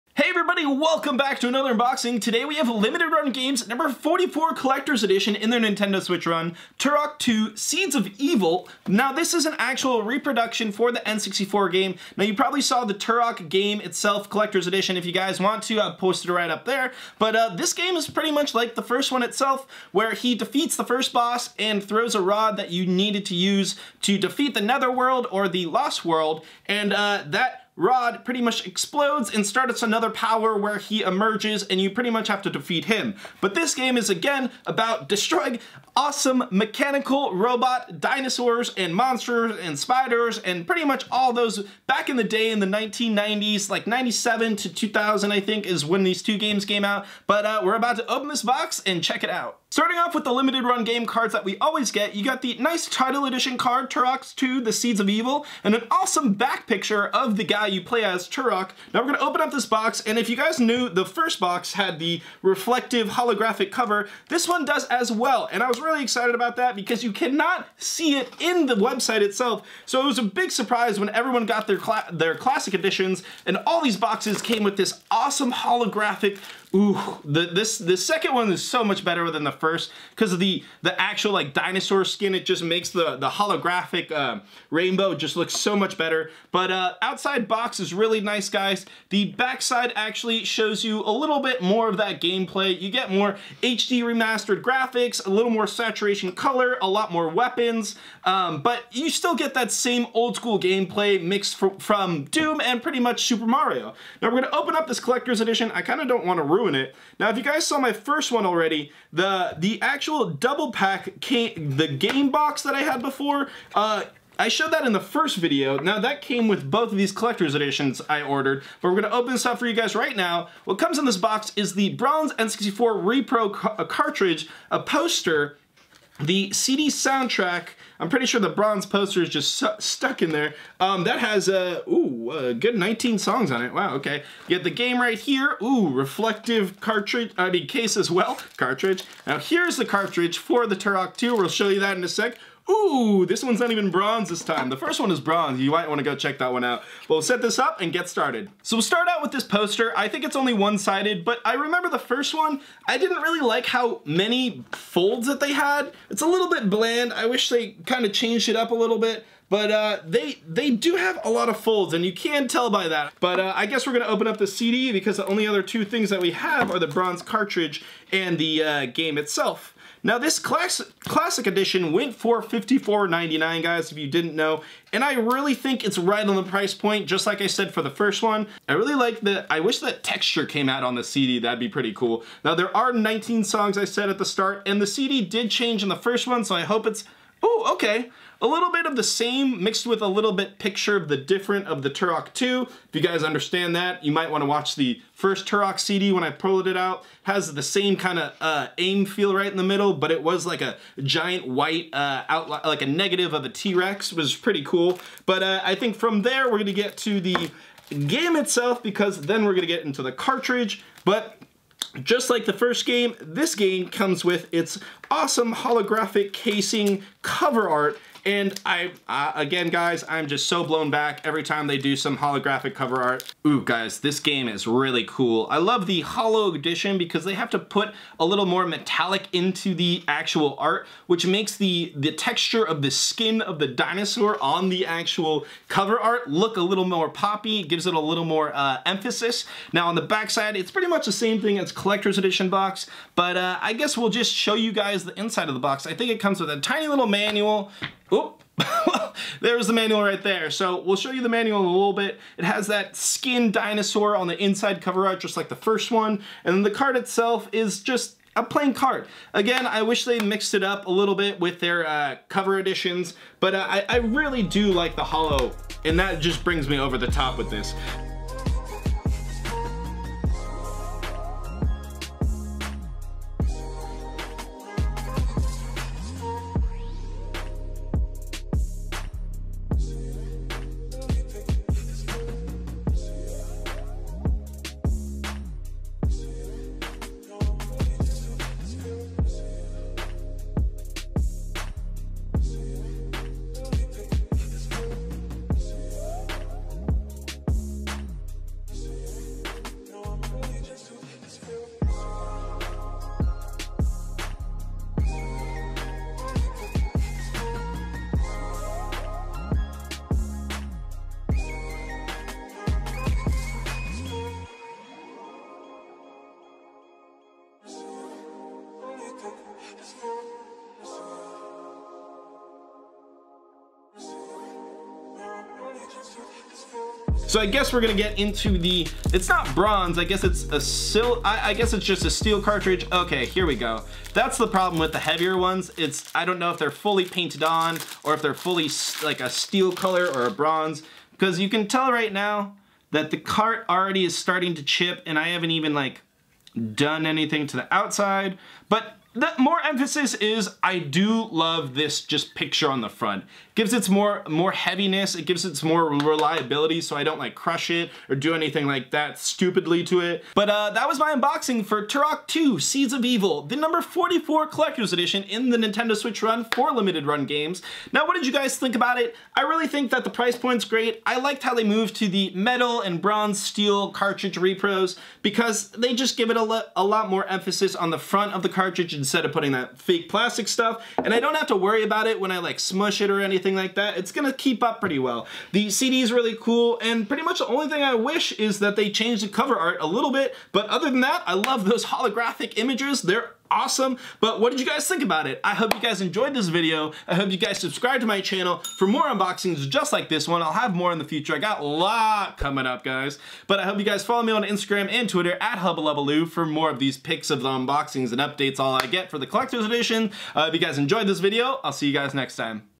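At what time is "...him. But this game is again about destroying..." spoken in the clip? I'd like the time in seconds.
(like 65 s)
32 s.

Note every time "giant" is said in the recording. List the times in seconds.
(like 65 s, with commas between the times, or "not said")
201 s.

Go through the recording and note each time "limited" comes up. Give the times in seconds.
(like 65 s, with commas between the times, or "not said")
2 s, 50 s, 366 s.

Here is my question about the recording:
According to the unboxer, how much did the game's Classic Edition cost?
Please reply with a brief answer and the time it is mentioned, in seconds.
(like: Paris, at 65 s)
$54.99, at 172 s.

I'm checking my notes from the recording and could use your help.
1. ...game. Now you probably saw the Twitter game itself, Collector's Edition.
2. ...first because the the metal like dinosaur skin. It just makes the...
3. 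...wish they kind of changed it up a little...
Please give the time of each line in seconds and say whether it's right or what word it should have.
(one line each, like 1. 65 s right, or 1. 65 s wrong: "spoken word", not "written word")
1. 11 s wrong: "Turok", not "Twitter"
2. 79 s wrong: "actual", not "metal"
3. 157 s right.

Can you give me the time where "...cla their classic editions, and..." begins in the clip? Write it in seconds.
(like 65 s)
71 s.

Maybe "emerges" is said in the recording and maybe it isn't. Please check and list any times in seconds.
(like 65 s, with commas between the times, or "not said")
31 s.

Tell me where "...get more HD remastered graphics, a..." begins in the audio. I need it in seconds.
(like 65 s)
92 s.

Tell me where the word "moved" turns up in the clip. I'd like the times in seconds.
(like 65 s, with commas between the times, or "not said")
371 s.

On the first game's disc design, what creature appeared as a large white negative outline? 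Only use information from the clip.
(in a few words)
T-Rex.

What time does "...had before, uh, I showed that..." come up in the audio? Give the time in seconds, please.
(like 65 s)
112 s.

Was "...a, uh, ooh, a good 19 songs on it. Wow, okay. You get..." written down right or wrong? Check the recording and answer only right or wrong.
right.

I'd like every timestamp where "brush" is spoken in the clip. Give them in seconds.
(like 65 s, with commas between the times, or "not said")
not said.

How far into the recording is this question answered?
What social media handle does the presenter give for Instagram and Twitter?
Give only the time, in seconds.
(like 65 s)
405 s.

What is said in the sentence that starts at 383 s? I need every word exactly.
It's gonna keep up pretty well.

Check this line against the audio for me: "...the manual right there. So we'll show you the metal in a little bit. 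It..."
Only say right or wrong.
wrong.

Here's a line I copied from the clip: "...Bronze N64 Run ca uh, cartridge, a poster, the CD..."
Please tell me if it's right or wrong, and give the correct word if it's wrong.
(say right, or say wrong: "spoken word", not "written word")
wrong: "Repro", not "Run".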